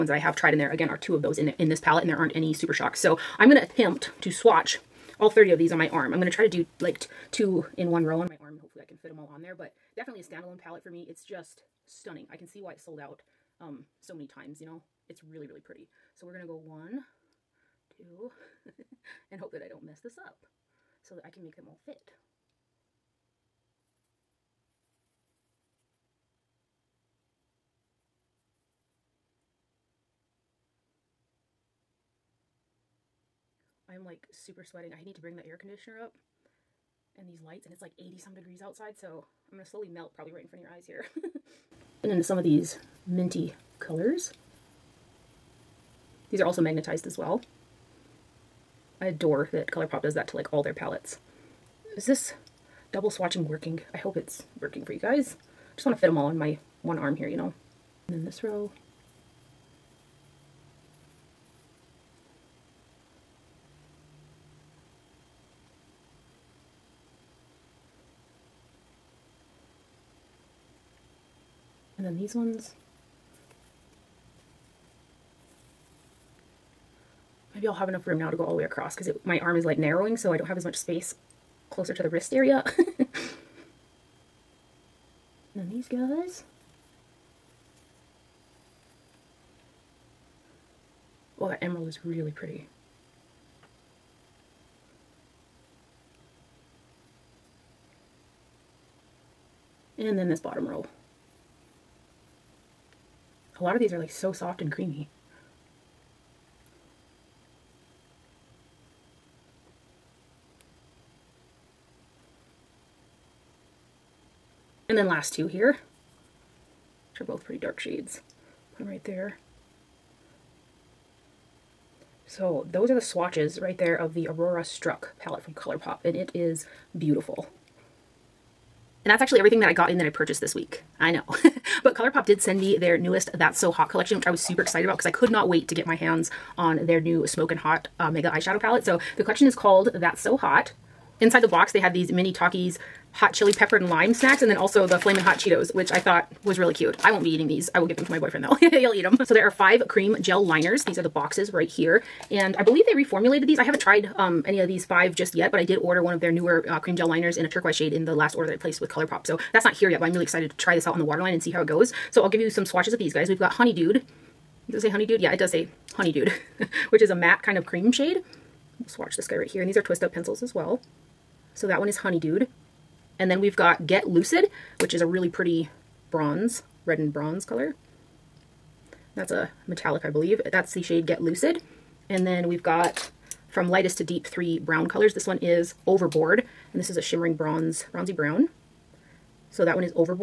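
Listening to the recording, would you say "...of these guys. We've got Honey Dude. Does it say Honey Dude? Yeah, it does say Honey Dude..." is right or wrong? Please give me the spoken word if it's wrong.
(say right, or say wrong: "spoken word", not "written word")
right.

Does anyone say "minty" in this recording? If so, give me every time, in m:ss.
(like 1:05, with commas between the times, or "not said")
0:43.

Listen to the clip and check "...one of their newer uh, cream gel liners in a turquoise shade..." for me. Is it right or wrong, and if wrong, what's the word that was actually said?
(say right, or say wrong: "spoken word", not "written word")
right.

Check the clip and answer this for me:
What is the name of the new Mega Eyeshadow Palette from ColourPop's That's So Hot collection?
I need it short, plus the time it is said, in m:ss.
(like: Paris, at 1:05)
Smokin' Hot, at 2:17.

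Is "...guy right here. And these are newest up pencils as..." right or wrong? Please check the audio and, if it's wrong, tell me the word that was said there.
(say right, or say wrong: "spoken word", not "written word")
wrong: "twist", not "newest".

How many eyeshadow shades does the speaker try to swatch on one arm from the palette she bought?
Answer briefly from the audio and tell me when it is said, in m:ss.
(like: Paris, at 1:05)
30, at 0:05.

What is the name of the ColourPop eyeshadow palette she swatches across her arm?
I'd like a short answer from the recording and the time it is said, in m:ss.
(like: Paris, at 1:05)
Aurora Struck, at 2:04.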